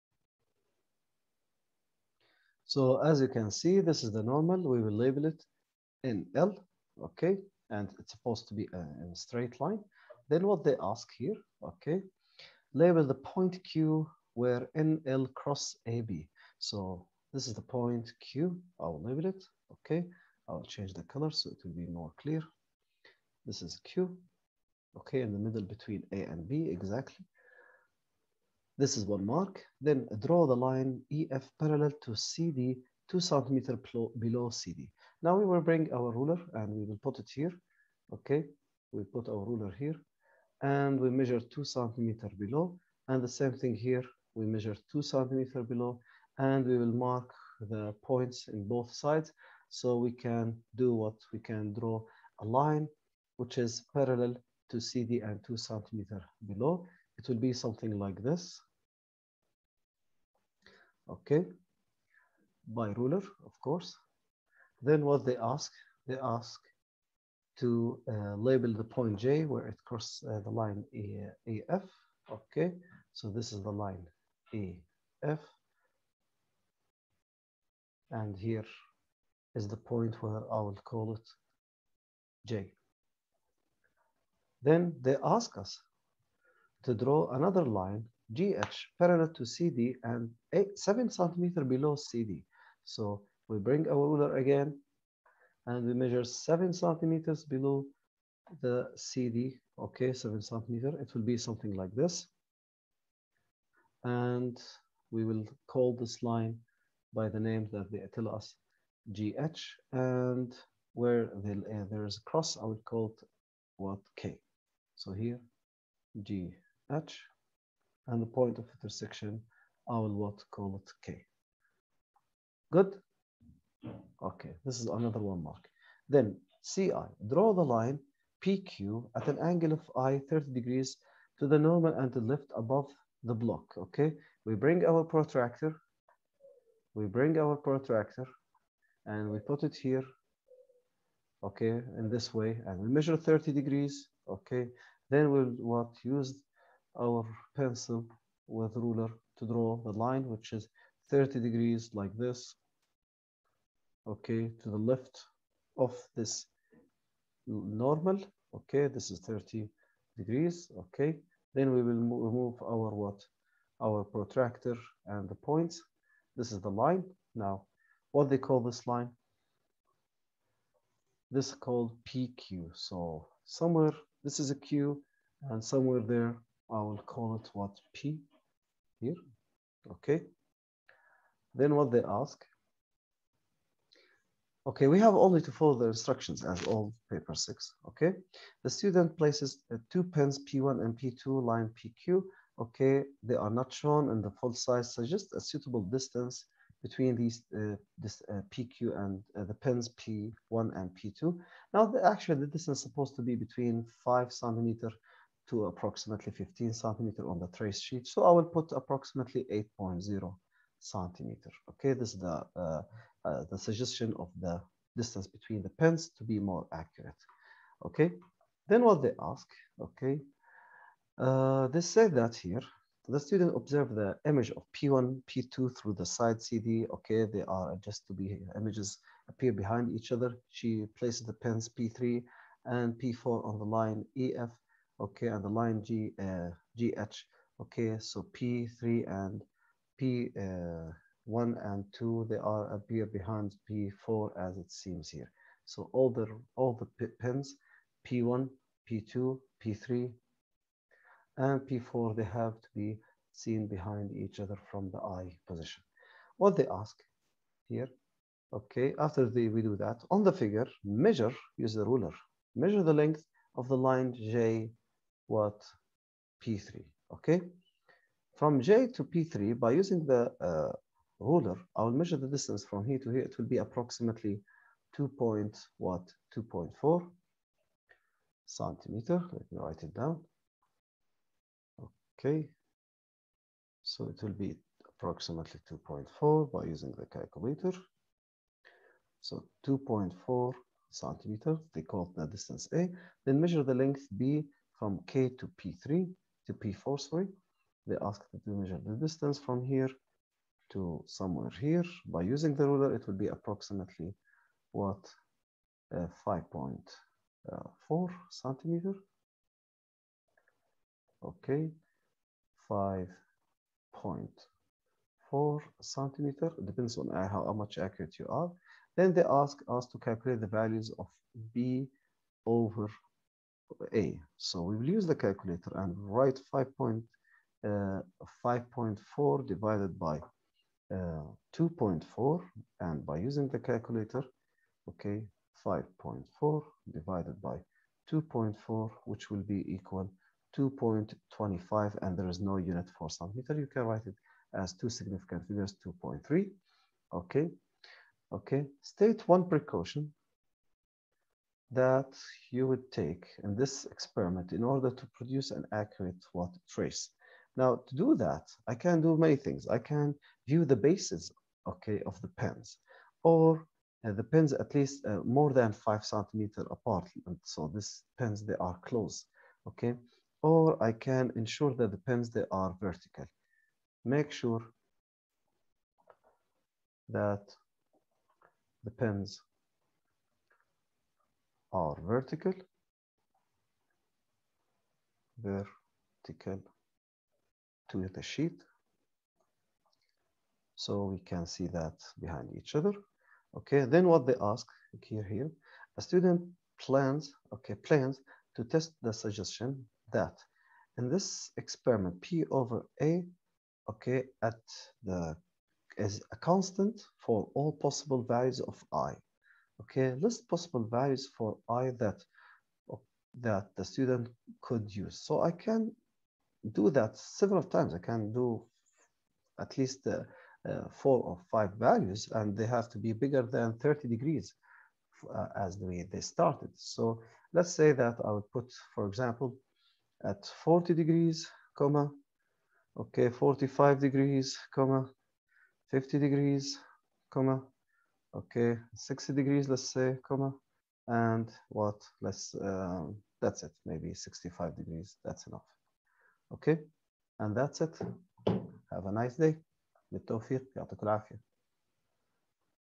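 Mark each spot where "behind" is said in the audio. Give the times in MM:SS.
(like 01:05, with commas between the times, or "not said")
03:49, 04:03, 04:13, 06:32.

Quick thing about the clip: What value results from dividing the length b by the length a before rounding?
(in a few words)
2.25.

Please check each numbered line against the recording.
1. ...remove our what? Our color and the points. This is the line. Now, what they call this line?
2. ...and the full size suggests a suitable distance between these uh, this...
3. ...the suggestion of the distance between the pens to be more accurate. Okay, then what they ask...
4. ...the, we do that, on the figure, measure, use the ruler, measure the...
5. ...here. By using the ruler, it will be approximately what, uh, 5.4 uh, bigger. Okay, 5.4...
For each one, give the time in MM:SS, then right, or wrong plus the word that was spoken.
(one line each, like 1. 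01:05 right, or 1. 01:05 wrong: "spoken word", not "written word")
1. 02:41 wrong: "protractor", not "color"
2. 03:14 right
3. 03:33 right
4. 04:19 right
5. 05:01 wrong: "centimeter", not "bigger".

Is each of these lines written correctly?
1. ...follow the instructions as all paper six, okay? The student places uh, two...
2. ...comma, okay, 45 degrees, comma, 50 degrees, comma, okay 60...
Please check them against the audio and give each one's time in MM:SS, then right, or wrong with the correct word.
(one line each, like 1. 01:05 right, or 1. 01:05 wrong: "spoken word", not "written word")
1. 03:05 right
2. 07:11 right.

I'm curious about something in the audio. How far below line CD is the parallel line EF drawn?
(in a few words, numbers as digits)
2 cm.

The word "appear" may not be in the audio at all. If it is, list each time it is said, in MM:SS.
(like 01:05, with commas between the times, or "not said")
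03:49, 04:02.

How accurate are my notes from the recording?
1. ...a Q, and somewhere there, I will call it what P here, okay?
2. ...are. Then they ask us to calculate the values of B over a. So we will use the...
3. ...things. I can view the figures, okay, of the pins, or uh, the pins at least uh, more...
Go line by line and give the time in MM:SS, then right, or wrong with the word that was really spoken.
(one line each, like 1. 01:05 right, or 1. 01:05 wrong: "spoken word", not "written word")
1. 02:54 right
2. 05:18 right
3. 05:59 wrong: "bases", not "figures".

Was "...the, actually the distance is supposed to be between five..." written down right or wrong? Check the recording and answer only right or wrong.
right.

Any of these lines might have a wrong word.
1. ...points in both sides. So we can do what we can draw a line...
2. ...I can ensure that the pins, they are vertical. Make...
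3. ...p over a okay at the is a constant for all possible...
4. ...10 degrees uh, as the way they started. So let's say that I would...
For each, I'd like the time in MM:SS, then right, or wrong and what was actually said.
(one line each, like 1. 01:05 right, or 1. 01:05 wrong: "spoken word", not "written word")
1. 00:48 right
2. 06:10 right
3. 06:42 right
4. 07:03 wrong: "30", not "10".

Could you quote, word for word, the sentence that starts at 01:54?
So here GH and the point of intersection, I will what call it K.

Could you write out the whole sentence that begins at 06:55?
So I can do that several times.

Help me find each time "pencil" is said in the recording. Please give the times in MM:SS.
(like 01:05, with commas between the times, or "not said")
02:27.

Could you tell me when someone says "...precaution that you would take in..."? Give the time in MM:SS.
05:49.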